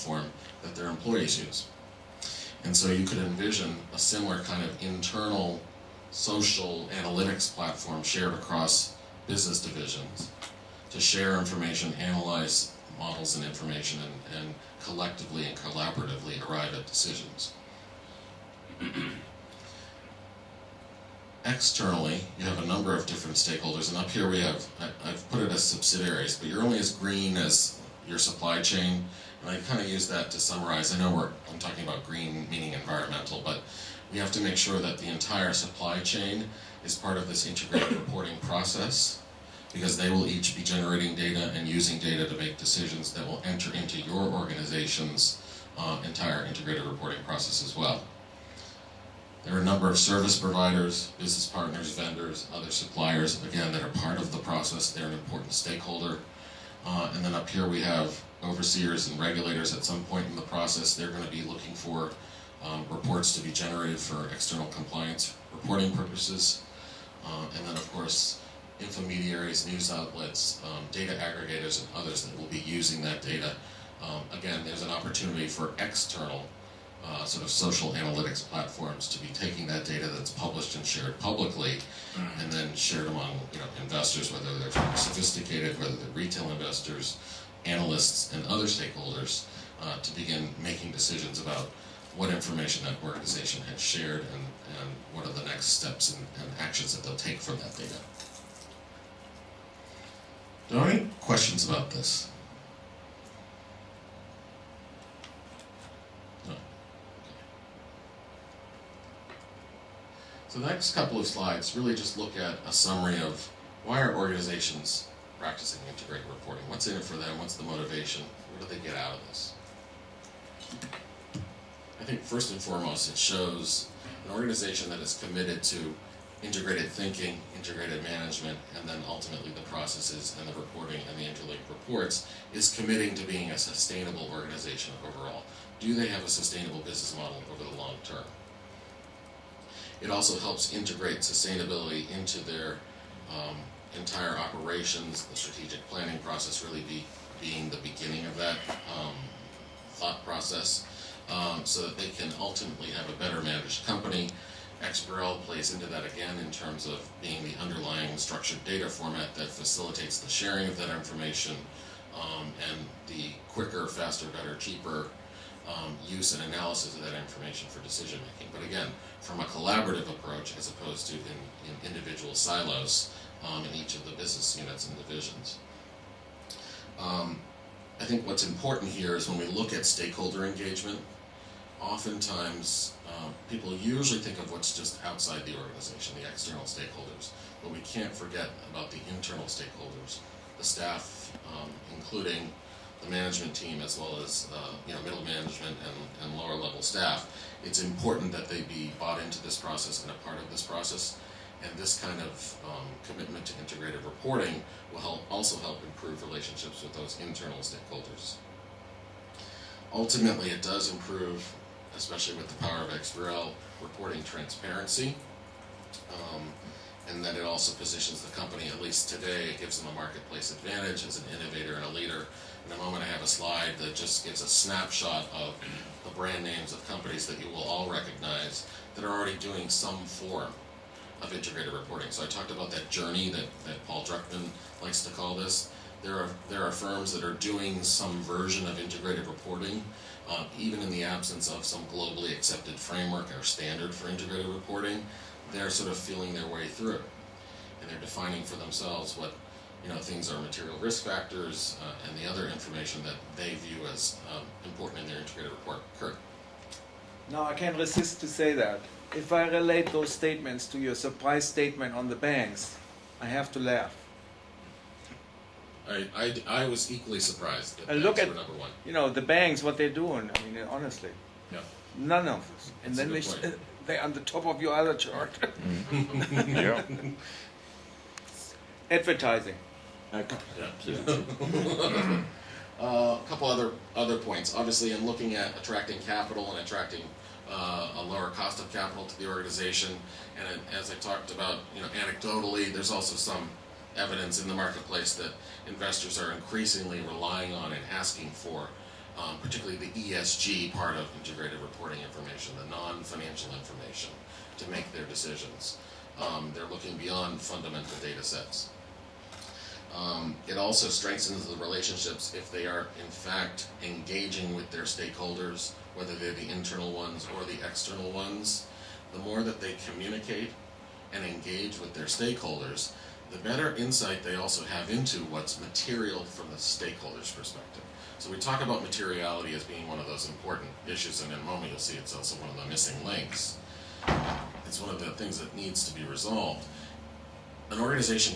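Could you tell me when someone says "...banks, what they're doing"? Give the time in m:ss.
4:29.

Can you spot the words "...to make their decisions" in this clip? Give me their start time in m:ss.
5:04.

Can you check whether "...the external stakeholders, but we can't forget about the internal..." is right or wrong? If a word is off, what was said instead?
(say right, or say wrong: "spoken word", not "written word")
right.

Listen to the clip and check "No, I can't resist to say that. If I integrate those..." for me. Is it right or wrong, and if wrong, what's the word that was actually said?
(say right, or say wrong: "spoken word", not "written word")
wrong: "relate", not "integrate".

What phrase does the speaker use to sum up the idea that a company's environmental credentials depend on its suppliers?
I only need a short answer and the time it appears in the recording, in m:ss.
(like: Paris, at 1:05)
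You're only as green as your supply chain, at 0:26.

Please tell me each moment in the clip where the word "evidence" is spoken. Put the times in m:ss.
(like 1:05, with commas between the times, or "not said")
4:53.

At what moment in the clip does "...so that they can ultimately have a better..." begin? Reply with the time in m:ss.
2:31.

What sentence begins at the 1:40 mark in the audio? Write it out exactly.
Are there any questions about this?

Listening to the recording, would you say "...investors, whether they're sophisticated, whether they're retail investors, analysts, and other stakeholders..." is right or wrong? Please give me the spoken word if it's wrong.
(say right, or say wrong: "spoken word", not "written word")
right.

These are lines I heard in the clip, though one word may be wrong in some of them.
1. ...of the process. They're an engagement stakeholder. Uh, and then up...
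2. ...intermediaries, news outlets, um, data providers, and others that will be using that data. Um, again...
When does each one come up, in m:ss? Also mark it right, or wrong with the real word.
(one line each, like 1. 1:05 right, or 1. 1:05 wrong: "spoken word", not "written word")
1. 0:54 wrong: "important", not "engagement"
2. 1:08 wrong: "aggregators", not "providers".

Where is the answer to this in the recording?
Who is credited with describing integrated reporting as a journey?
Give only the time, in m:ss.
3:53.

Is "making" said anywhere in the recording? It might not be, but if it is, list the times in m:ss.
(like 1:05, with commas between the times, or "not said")
1:30, 2:48.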